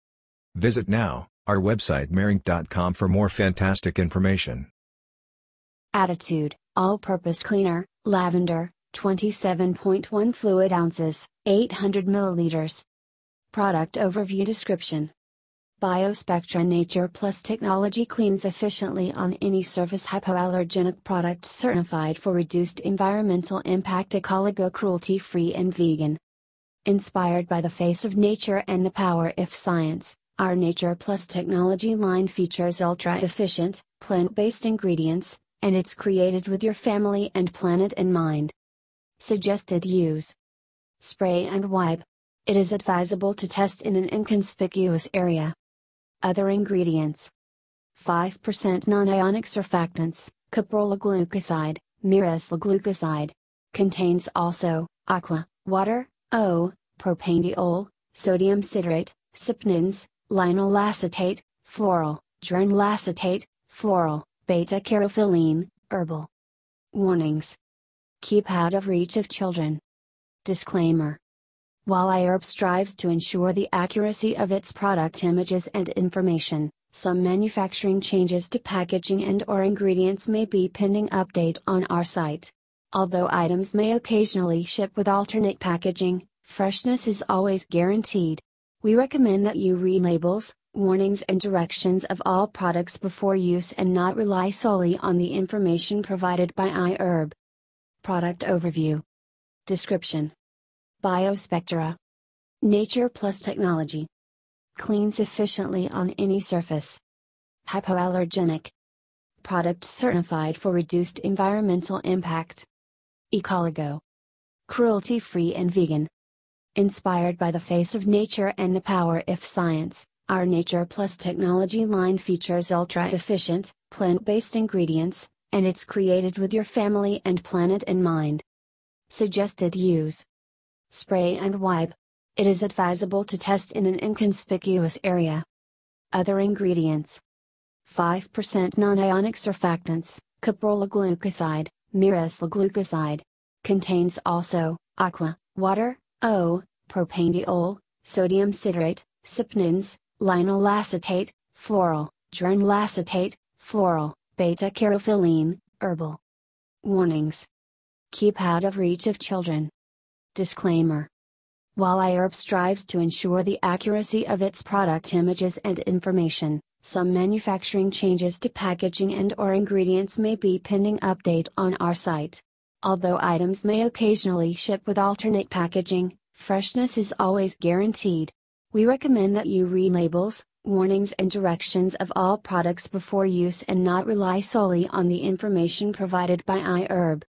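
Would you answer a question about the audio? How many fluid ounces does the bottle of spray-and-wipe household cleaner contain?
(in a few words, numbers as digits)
27.1 fluid ounces.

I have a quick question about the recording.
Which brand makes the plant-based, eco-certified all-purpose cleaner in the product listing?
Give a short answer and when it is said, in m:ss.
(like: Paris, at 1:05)
Attitude, at 0:05.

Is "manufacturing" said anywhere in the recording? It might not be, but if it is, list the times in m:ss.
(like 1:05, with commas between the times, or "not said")
1:17, 2:47.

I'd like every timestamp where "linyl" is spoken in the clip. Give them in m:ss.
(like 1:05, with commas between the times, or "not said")
1:00, 2:30.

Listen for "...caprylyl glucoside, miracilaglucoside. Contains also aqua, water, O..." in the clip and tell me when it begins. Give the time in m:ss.
2:20.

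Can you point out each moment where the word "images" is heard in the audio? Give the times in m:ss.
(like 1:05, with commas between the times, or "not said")
1:15, 2:45.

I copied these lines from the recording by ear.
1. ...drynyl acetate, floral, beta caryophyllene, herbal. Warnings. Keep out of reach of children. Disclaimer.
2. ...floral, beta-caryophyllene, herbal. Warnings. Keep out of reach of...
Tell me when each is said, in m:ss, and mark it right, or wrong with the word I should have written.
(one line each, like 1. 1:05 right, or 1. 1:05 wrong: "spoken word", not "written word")
1. 1:02 wrong: "geranyl", not "drynyl"
2. 2:33 right.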